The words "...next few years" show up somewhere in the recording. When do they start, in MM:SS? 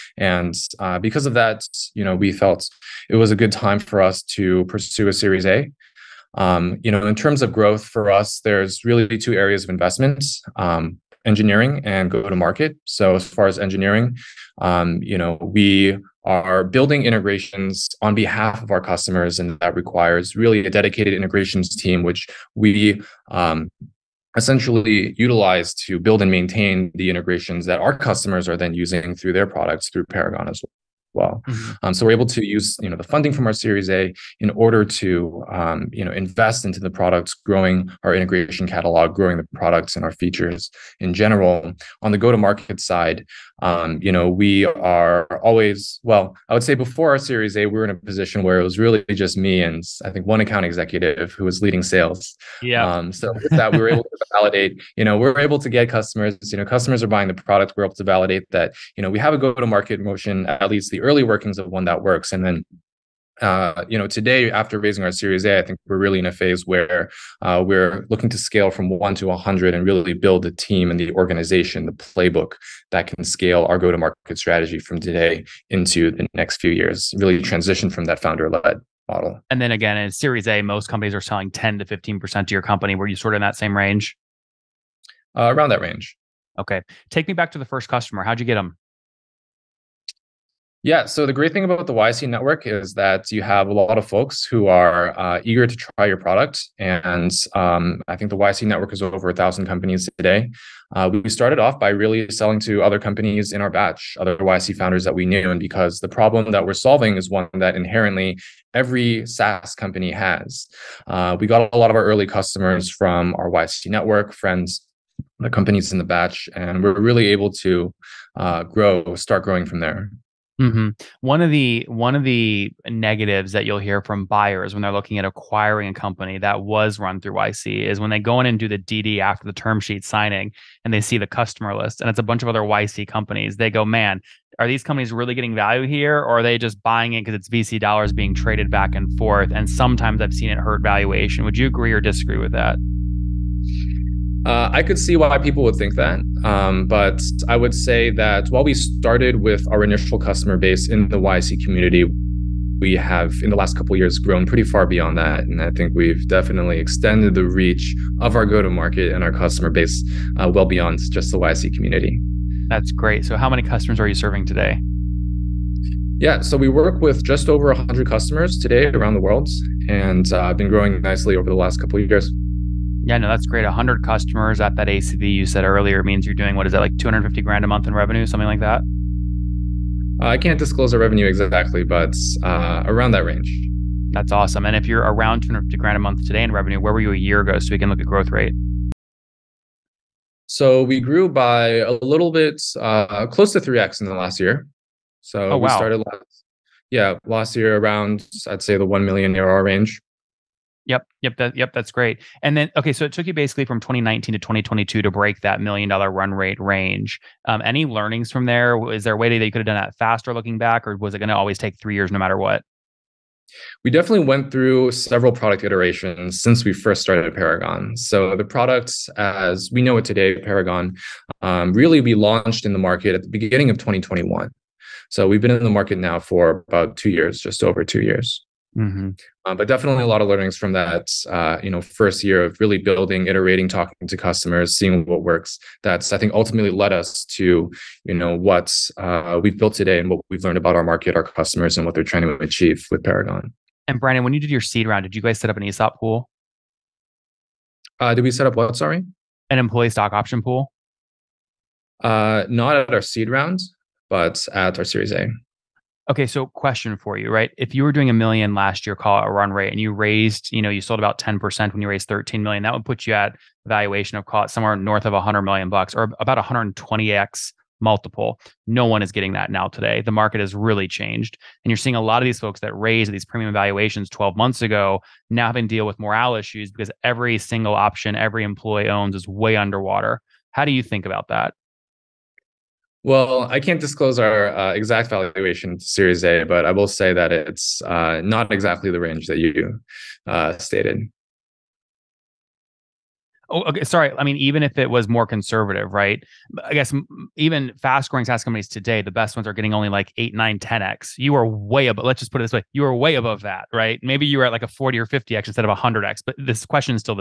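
01:16.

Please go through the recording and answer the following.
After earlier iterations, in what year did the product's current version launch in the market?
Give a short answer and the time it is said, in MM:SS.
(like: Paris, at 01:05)
2021, at 03:43.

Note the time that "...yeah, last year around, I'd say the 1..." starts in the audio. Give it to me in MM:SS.
03:16.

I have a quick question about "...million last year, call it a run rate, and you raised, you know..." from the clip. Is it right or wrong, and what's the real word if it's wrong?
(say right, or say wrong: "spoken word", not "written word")
right.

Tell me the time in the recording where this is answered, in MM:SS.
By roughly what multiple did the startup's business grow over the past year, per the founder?
03:13.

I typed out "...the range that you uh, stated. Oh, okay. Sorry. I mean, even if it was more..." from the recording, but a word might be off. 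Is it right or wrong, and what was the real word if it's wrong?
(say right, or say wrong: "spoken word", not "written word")
right.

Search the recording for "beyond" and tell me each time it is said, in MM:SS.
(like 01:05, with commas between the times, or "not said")
02:34, 02:40.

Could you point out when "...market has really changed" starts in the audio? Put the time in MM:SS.
04:30.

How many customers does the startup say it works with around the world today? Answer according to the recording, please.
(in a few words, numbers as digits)
just over 100.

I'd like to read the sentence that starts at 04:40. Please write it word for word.
How do you think about that?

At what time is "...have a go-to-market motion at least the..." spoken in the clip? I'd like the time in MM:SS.
00:59.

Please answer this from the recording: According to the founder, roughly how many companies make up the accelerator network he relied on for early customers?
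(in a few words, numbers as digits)
over 1000.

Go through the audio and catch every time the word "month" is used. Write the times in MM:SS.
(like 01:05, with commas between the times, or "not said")
02:57, 03:05, 04:34.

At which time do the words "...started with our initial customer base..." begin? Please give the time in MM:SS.
02:28.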